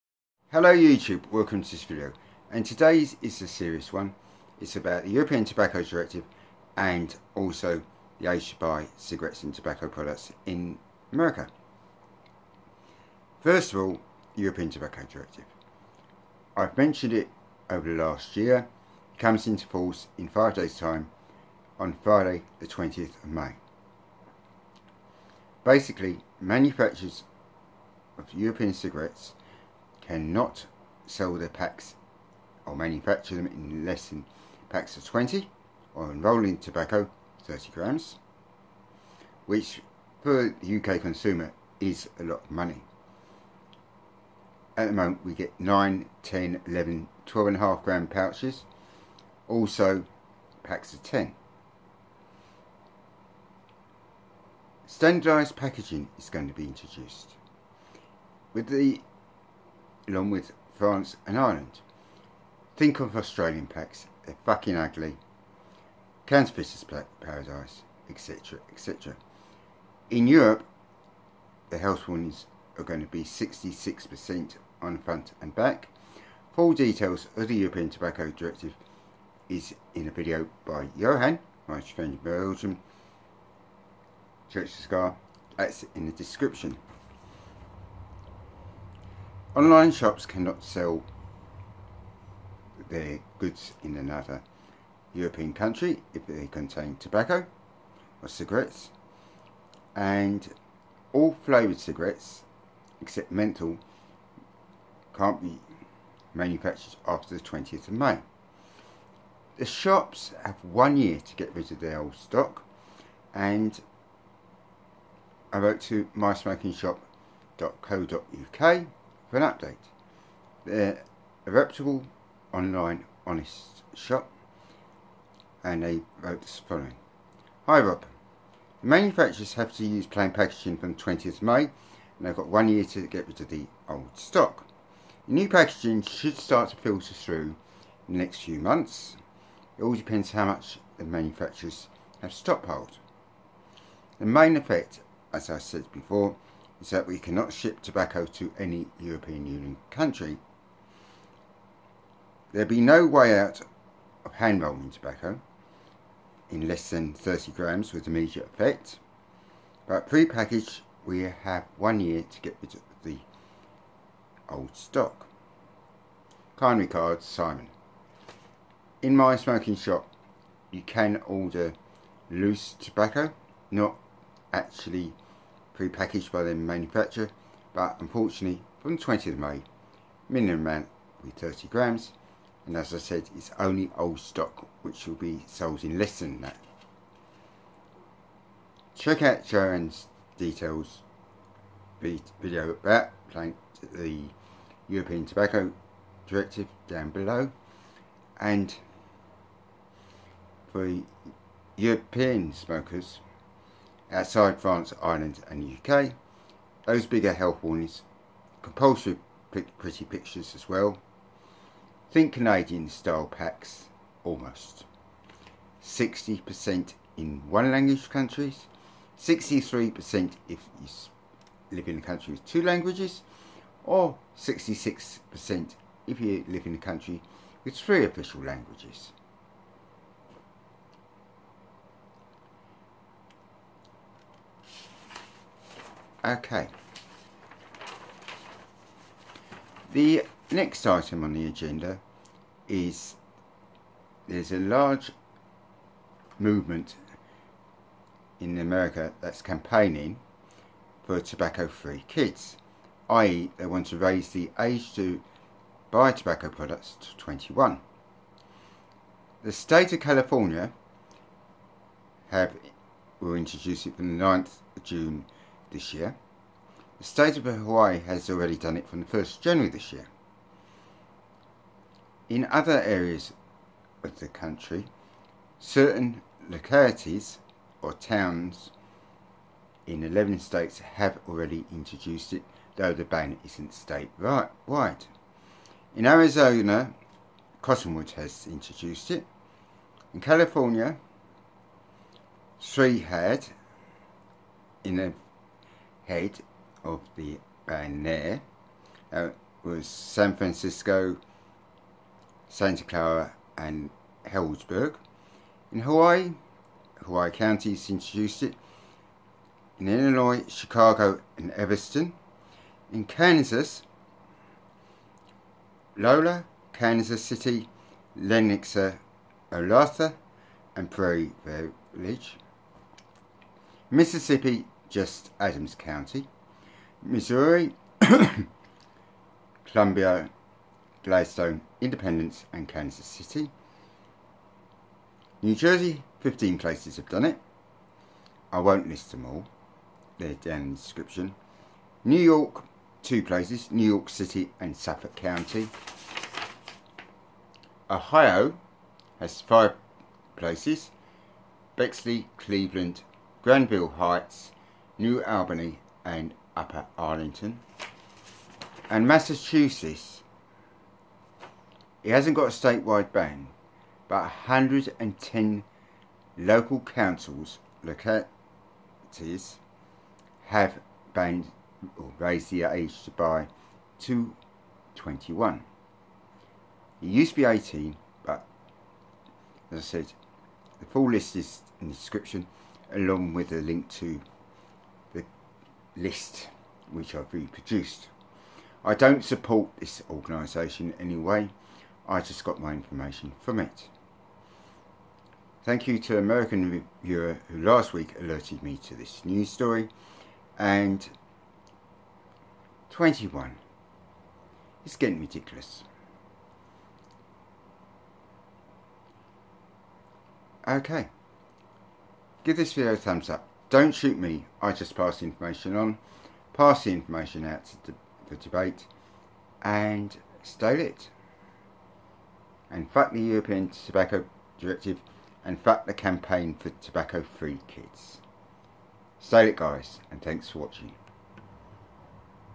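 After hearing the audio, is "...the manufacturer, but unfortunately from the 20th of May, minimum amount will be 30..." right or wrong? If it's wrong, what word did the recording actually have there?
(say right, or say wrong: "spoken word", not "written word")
right.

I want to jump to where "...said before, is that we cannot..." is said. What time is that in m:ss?
2:25.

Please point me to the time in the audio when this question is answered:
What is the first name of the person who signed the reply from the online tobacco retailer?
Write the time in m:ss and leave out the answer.
2:47.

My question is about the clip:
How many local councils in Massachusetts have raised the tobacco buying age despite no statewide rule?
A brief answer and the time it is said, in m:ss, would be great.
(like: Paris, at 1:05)
110, at 6:04.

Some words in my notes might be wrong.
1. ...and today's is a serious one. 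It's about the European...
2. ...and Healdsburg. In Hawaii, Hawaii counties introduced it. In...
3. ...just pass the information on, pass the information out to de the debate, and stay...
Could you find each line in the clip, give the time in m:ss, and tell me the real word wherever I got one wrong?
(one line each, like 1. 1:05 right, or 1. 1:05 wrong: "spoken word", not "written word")
1. 0:02 right
2. 5:03 right
3. 6:54 right.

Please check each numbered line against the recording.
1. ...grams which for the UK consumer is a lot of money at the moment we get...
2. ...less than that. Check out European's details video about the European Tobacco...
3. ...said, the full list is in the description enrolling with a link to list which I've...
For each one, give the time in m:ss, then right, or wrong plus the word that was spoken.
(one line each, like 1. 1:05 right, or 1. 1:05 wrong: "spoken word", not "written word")
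1. 0:37 right
2. 3:05 wrong: "Johan", not "European"
3. 6:19 wrong: "along", not "enrolling".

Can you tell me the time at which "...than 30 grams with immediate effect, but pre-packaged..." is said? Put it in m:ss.
2:36.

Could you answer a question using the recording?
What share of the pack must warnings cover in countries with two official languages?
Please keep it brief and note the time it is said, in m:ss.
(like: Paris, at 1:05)
63%, at 3:39.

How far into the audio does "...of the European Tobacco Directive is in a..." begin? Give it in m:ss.
1:17.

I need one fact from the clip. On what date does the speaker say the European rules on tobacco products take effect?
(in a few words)
Friday 20 May.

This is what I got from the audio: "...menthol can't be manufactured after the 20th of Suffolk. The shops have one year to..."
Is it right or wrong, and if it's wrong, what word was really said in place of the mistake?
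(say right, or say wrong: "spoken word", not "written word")
wrong: "May", not "Suffolk".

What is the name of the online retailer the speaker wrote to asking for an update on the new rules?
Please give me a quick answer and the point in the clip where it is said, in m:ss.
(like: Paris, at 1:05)
mysmokingshop.co.uk, at 1:56.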